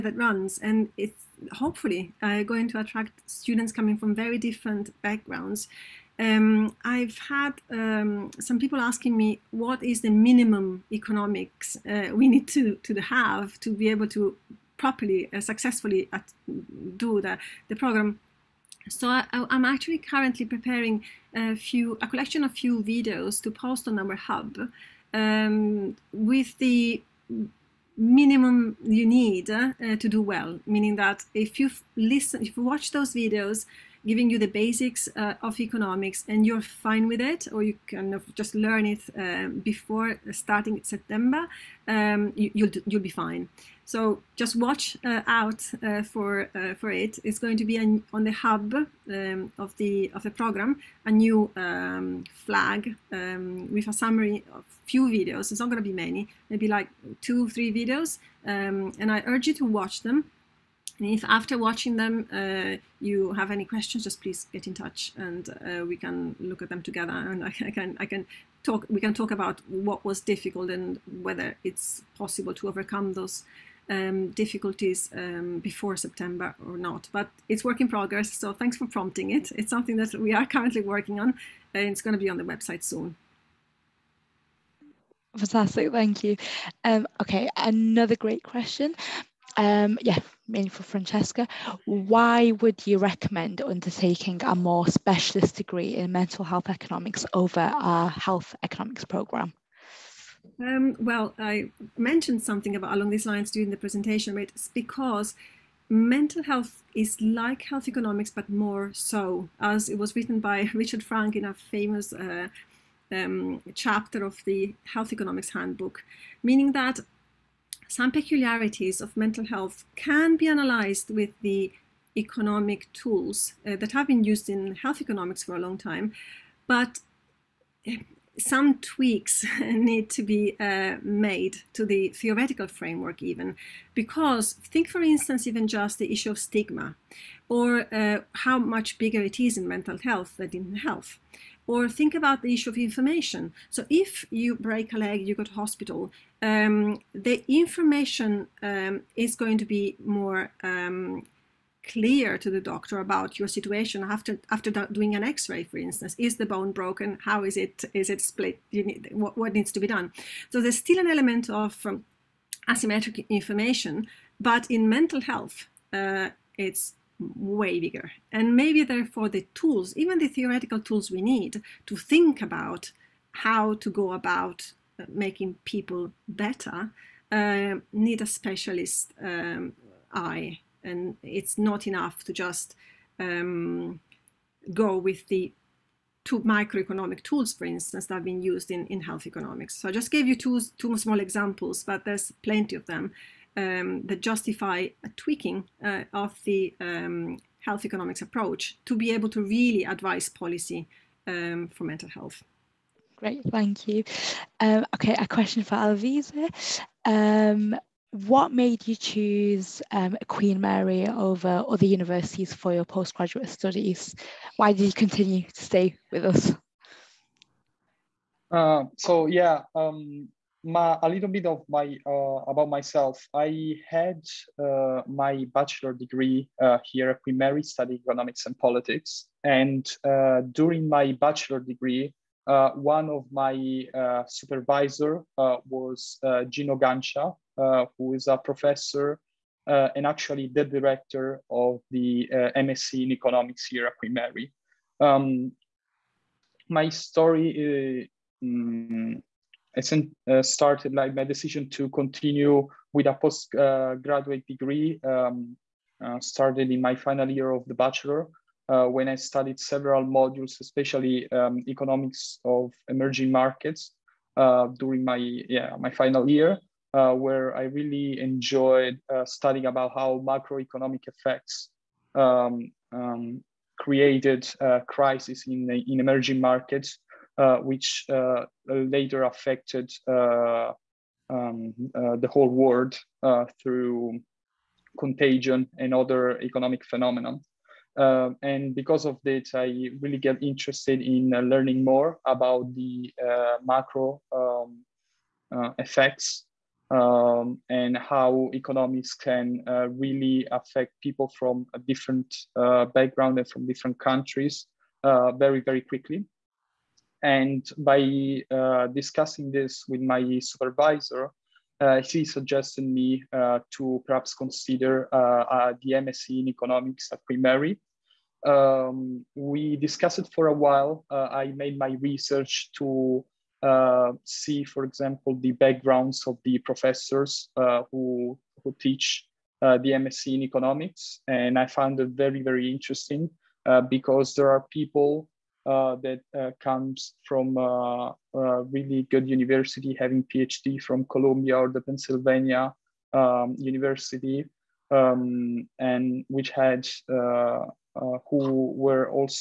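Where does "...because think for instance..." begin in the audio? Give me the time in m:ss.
2:13.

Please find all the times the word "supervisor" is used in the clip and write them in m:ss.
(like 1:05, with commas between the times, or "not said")
3:54, 5:10.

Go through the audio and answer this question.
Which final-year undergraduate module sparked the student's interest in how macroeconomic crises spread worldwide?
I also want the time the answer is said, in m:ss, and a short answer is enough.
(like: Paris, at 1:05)
Economics of emerging markets, at 4:21.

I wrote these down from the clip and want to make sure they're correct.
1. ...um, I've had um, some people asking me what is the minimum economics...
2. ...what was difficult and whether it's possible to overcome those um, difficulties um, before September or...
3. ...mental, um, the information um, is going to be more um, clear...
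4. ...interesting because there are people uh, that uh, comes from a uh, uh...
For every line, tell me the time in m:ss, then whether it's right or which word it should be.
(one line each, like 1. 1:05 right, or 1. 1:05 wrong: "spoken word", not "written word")
1. 0:06 right
2. 1:09 right
3. 2:25 wrong: "hospital", not "mental"
4. 5:32 right.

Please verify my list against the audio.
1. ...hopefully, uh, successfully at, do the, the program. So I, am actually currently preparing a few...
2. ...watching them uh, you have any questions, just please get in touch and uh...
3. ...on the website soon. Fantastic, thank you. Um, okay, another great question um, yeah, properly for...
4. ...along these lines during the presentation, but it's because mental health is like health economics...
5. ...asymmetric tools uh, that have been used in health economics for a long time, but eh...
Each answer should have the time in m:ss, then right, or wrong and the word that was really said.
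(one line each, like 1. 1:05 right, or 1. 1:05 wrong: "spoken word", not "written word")
1. 0:14 wrong: "properly", not "hopefully"
2. 1:01 right
3. 1:22 wrong: "mainly", not "properly"
4. 1:42 right
5. 2:02 wrong: "economic", not "asymmetric".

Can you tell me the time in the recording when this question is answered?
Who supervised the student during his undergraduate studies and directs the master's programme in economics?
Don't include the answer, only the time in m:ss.
3:56.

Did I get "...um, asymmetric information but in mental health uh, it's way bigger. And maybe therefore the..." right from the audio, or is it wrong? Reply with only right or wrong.
right.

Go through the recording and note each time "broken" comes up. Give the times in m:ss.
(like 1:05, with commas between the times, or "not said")
2:36.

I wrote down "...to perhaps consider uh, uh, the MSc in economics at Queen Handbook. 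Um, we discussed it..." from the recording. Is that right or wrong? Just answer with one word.
wrong.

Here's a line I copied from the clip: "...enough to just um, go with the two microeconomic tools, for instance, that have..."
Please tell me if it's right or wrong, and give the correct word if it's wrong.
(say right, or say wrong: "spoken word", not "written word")
right.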